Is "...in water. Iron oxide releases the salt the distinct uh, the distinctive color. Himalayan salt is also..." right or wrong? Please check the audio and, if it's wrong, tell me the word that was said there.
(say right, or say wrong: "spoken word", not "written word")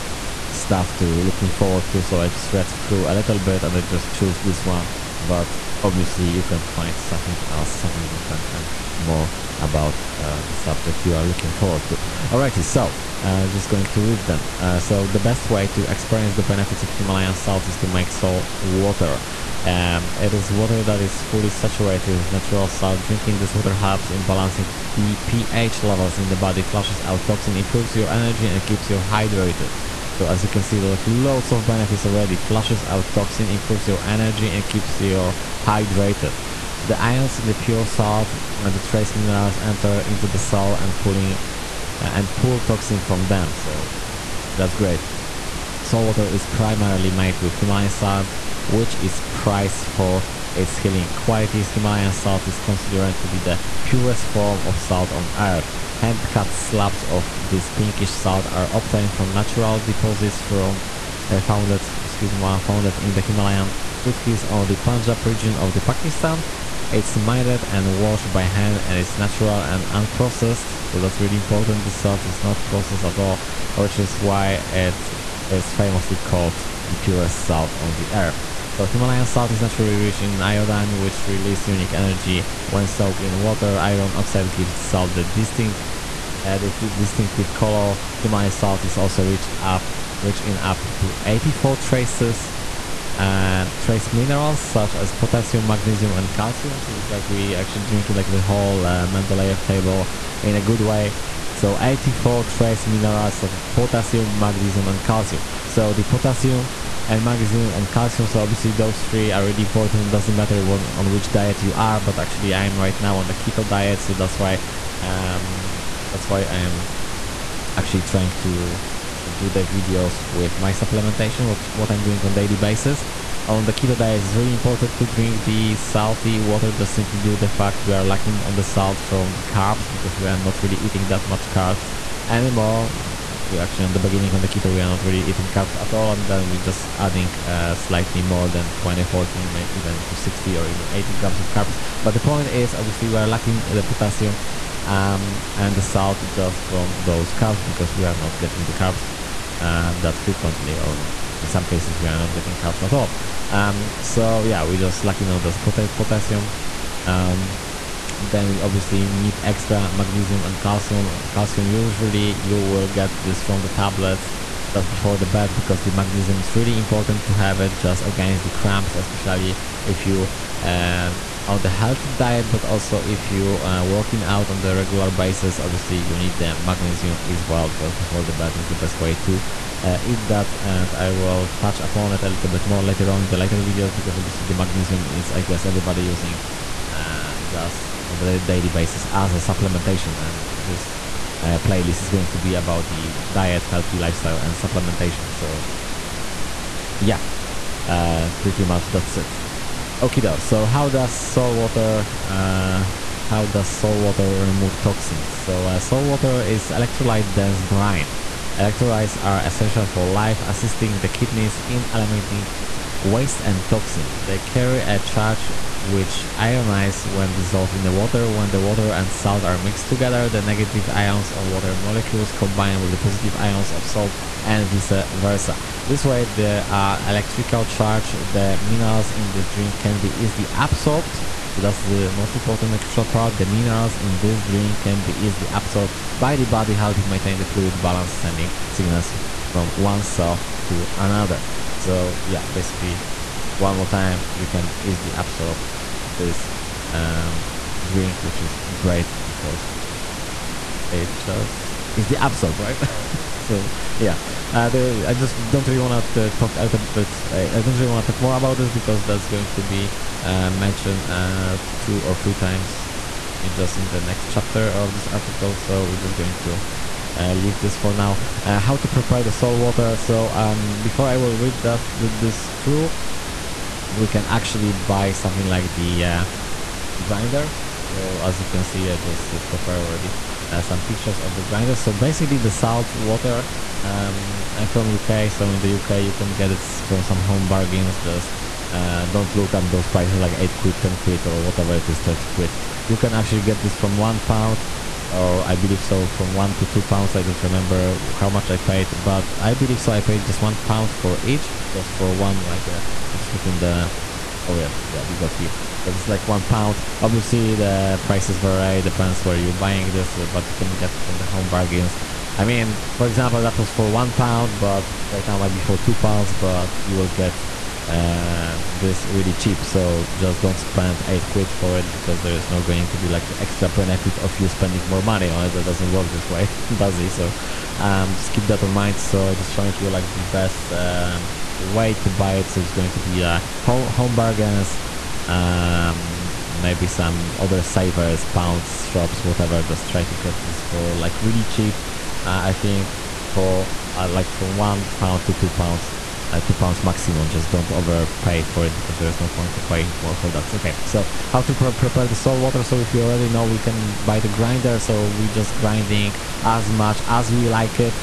wrong: "gives", not "releases".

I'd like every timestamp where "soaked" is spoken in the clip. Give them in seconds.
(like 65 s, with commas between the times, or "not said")
82 s.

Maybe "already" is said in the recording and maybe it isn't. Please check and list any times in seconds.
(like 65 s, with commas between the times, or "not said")
32 s, 279 s, 353 s.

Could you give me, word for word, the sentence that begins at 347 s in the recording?
Just don't overpay for it because there's no point to paying more for that.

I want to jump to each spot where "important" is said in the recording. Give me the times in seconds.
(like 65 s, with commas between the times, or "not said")
71 s, 109 s, 124 s, 166 s, 232 s.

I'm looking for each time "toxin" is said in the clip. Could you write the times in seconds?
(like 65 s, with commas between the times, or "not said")
27 s, 33 s, 42 s, 204 s, 213 s.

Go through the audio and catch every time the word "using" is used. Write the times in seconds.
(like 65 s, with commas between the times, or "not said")
186 s.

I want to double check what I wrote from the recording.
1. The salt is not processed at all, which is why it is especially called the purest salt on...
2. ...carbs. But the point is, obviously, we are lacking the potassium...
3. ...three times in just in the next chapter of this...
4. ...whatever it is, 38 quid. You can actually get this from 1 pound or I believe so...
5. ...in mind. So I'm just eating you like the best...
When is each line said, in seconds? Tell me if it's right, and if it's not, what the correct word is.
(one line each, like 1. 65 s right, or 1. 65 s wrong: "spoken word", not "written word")
1. 71 s wrong: "famously", not "especially"
2. 141 s right
3. 262 s right
4. 291 s wrong: "30", not "38"
5. 328 s wrong: "showing", not "eating".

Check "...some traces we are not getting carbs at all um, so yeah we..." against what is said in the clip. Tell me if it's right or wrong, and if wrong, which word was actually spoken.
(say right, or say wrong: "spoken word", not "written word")
wrong: "cases", not "traces".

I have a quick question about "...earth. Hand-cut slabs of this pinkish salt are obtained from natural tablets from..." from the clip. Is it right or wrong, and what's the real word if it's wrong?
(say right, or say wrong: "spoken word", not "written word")
wrong: "deposits", not "tablets".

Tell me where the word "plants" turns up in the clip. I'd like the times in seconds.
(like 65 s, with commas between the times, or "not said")
not said.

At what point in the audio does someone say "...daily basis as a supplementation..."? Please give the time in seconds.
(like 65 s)
188 s.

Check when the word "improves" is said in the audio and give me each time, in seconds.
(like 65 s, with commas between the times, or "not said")
27 s, 33 s.